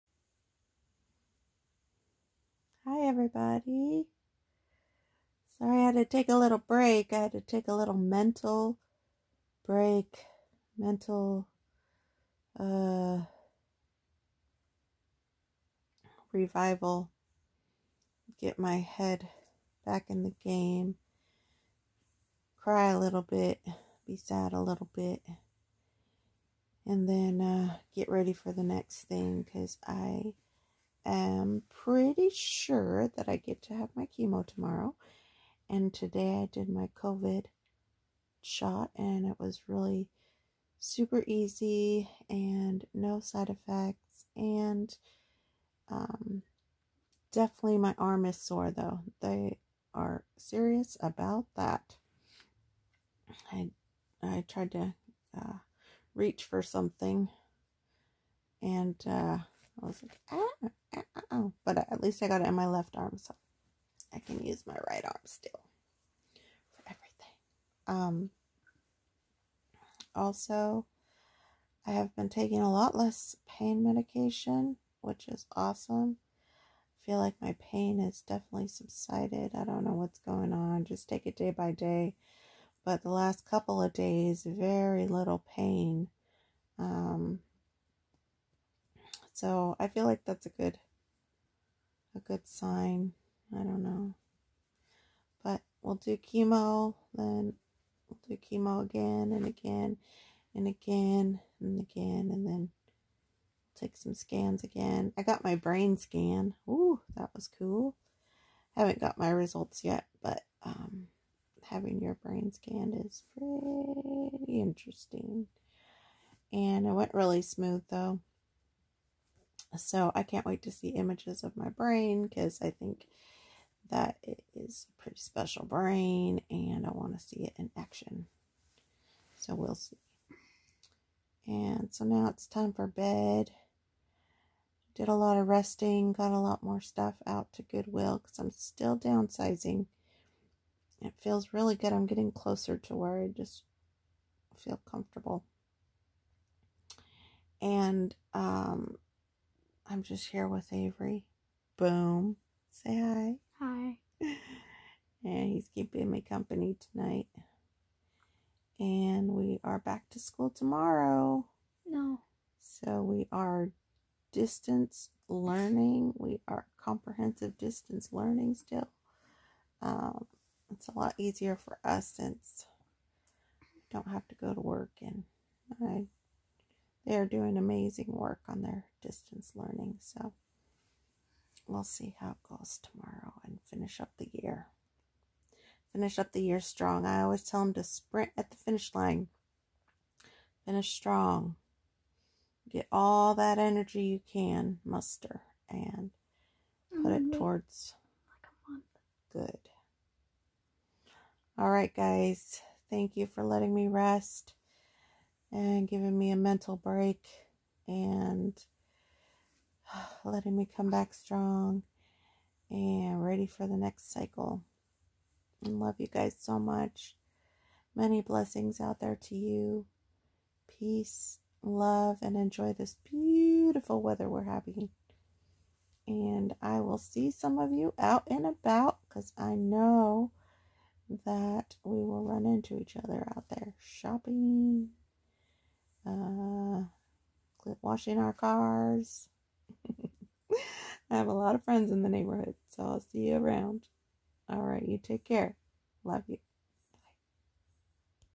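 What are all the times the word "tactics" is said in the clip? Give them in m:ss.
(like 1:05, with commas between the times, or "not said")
not said.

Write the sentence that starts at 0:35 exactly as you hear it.
And today I did my COVID shot, and it was really super easy and no side effects.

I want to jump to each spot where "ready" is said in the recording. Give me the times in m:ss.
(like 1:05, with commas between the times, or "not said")
0:28, 3:33.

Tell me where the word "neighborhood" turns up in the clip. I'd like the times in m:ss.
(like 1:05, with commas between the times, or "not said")
4:02.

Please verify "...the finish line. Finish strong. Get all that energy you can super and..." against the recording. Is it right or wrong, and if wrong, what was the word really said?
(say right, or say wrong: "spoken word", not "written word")
wrong: "muster", not "super".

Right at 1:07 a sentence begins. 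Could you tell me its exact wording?
Um, also, I have been taking a lot less pain medication, which is awesome.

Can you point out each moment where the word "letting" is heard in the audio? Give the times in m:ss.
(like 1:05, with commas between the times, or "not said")
3:23, 3:30.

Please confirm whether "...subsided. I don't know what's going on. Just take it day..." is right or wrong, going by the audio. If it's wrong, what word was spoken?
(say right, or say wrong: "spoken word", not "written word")
right.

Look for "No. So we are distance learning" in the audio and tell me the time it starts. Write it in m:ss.
2:41.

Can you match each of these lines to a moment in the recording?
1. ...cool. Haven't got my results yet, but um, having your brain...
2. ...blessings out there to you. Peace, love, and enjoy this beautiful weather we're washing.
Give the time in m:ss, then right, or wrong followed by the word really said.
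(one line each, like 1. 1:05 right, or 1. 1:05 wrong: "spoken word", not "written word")
1. 1:47 right
2. 3:38 wrong: "having", not "washing".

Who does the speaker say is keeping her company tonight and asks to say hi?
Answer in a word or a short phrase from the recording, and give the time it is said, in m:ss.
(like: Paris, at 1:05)
Avery, at 2:30.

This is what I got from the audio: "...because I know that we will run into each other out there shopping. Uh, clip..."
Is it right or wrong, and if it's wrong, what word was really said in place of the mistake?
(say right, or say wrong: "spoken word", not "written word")
right.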